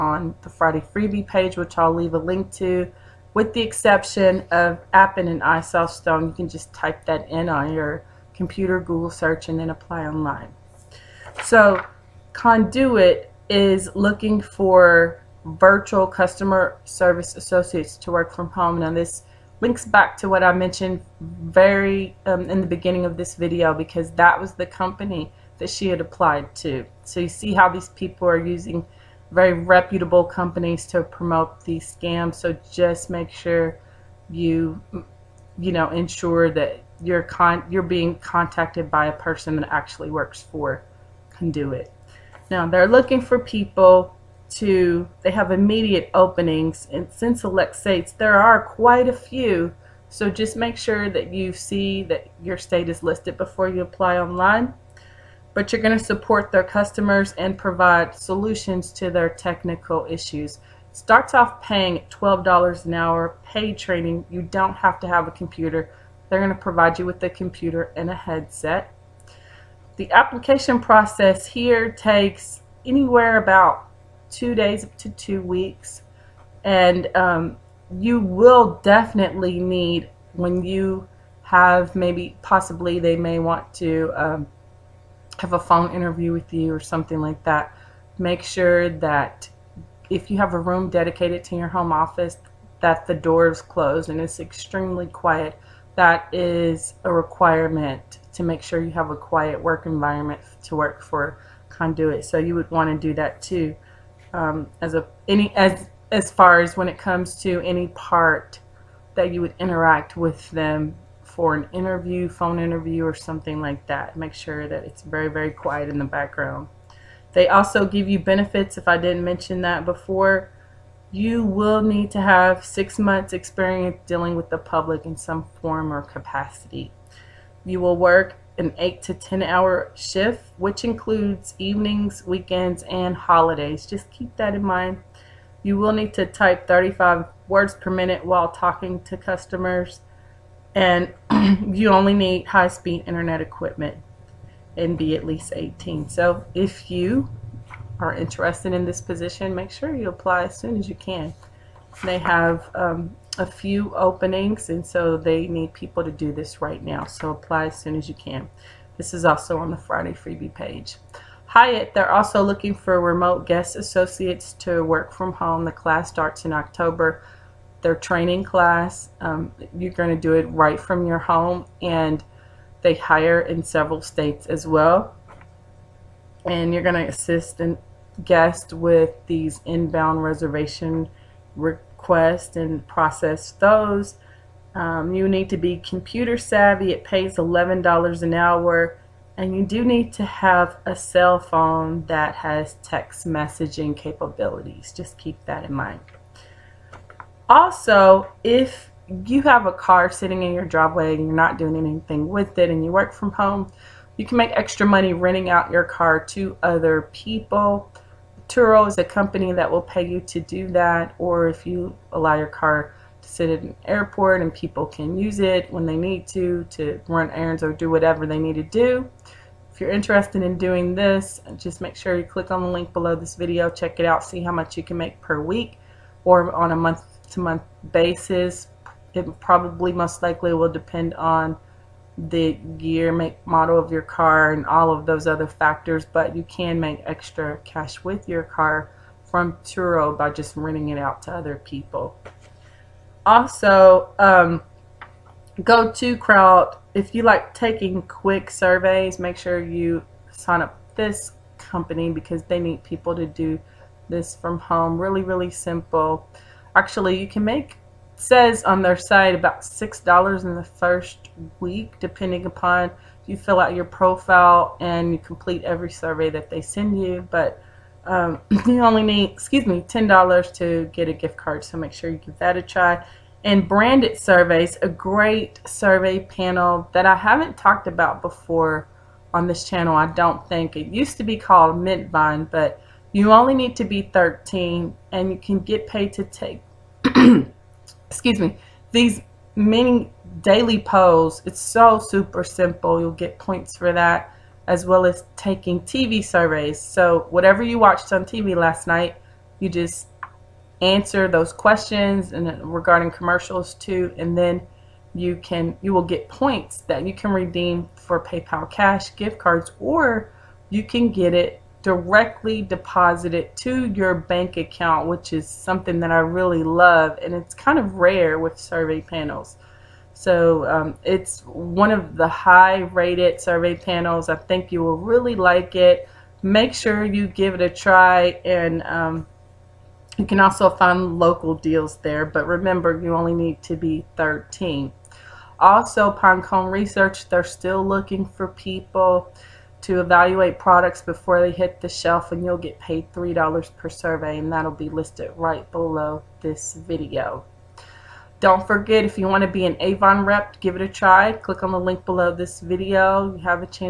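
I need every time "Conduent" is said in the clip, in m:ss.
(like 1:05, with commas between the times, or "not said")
0:12, 0:41, 1:41.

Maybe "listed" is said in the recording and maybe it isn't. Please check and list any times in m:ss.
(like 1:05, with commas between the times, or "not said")
0:53, 5:44.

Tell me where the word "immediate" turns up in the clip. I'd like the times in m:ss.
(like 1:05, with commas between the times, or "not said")
0:45.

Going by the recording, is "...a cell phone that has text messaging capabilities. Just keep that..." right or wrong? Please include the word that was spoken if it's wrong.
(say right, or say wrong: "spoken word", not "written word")
right.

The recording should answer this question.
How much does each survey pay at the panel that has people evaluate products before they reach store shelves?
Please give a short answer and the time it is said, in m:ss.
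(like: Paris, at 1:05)
$3, at 5:43.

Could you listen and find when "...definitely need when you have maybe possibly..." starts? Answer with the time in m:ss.
1:18.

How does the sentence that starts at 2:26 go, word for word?
So if you are interested in this position, make sure you apply as soon as you can.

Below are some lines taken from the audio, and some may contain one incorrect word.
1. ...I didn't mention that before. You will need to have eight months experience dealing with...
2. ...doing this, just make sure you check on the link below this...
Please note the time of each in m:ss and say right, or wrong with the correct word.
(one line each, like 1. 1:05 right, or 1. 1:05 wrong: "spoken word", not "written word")
1. 1:58 wrong: "six", not "eight"
2. 3:40 wrong: "click", not "check".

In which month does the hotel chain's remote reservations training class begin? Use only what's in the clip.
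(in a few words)
October.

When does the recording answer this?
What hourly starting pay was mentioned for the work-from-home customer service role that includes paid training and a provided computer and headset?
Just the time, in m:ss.
1:02.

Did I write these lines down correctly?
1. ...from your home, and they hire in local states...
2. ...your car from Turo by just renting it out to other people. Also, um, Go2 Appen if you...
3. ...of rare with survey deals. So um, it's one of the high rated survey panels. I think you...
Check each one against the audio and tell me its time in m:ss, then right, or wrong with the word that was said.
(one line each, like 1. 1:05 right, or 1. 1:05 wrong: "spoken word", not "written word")
1. 2:50 wrong: "several", not "local"
2. 3:58 wrong: "Crowd", not "Appen"
3. 5:17 wrong: "panels", not "deals".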